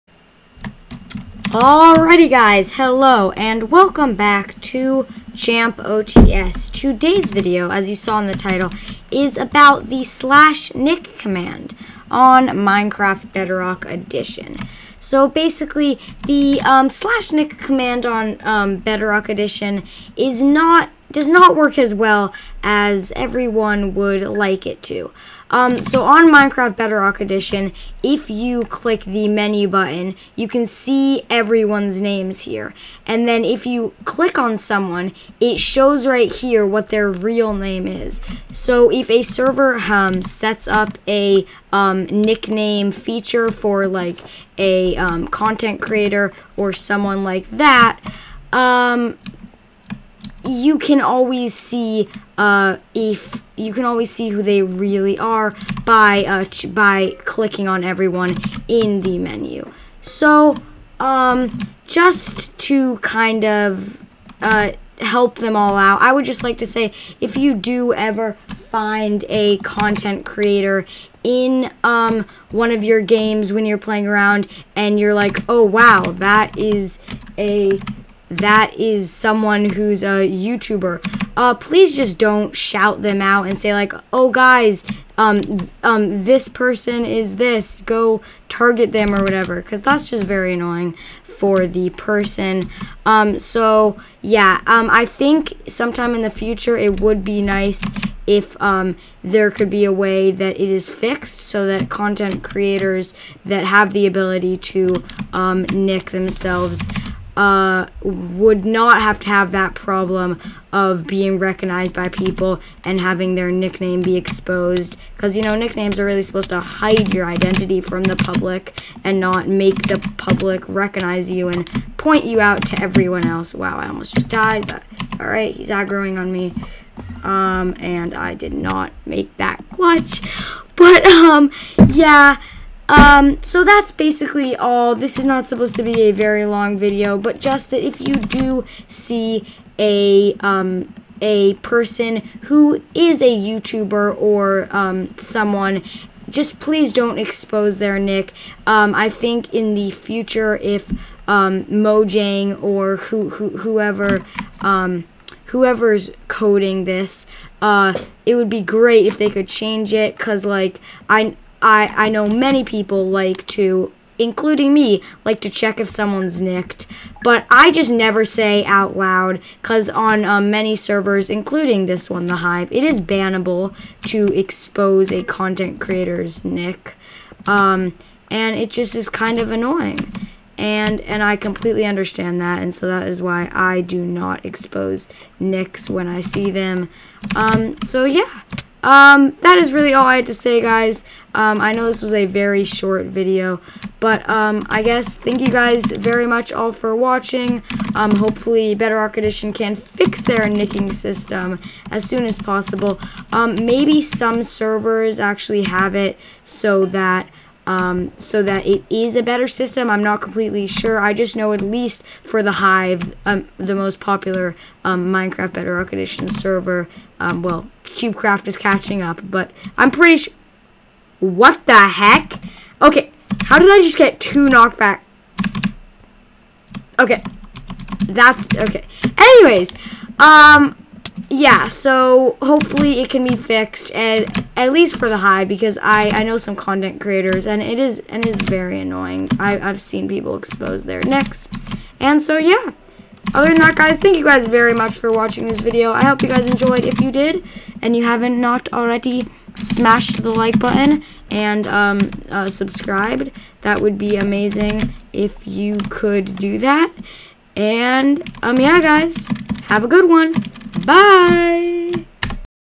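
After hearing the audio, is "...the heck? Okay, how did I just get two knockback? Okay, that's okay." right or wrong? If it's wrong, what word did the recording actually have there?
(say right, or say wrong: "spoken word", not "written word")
right.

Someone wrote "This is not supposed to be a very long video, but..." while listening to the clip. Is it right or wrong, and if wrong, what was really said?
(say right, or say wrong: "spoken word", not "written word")
right.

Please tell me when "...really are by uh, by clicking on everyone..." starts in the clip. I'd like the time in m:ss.
0:54.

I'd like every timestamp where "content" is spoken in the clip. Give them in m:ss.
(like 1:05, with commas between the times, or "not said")
0:45, 1:09, 1:41, 2:55, 3:56.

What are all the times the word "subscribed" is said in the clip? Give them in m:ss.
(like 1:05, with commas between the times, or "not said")
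4:12.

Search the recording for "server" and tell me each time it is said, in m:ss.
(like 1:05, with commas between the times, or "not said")
0:39, 2:50, 3:24, 3:36.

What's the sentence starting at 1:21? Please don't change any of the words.
Uh, please just don't shout them out and say like, oh guys, um, um, this person is this.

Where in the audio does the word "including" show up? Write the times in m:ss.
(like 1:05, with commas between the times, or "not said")
2:44, 2:51.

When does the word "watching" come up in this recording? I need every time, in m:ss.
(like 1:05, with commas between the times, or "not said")
3:16, 4:05.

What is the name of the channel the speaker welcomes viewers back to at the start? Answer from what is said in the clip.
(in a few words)
Champ OTS.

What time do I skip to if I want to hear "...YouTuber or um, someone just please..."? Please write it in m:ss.
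2:23.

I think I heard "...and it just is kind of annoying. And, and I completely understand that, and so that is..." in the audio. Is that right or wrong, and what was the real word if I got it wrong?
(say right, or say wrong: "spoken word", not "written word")
right.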